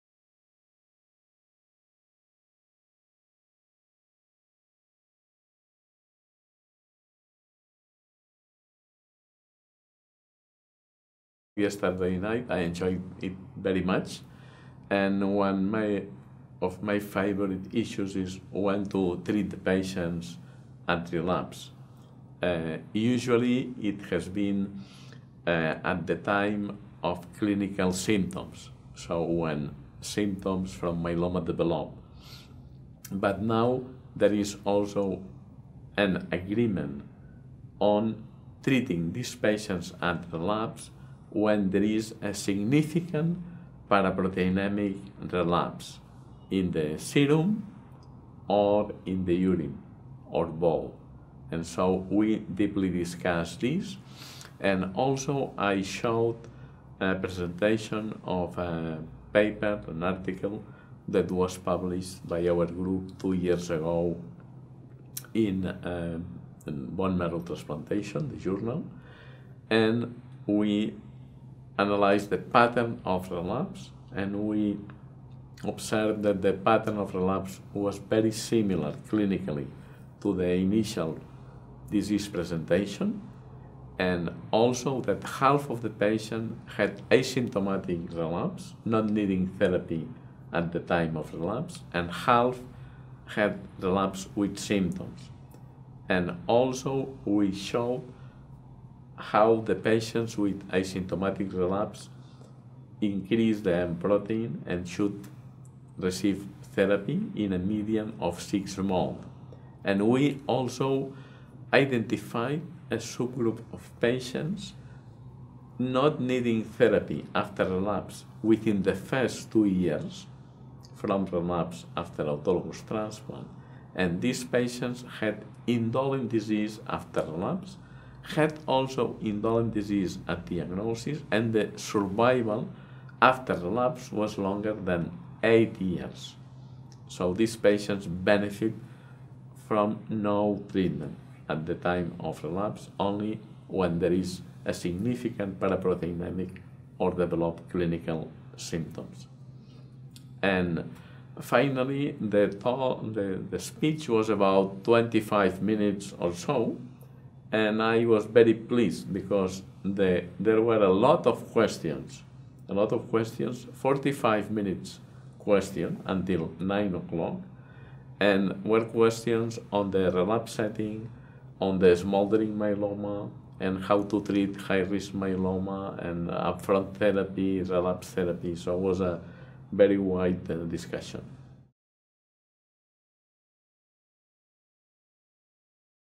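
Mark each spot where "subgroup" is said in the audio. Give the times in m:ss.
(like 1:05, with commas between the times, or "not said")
1:52.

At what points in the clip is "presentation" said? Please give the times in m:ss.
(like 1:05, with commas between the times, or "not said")
0:57, 1:22.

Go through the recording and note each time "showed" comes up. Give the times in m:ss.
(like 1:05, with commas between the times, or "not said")
0:55, 1:37.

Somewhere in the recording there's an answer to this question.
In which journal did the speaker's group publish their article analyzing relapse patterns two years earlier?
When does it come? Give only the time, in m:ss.
1:06.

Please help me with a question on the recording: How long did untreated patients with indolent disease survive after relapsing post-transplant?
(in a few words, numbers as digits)
8 years.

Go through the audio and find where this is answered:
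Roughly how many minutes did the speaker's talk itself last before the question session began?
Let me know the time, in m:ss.
2:34.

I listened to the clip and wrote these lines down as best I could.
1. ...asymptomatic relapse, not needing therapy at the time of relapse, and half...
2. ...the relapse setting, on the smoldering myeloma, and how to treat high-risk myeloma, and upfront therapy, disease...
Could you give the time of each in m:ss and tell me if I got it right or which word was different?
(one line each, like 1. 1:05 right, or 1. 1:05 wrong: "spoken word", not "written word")
1. 1:27 right
2. 2:49 wrong: "relapse", not "disease".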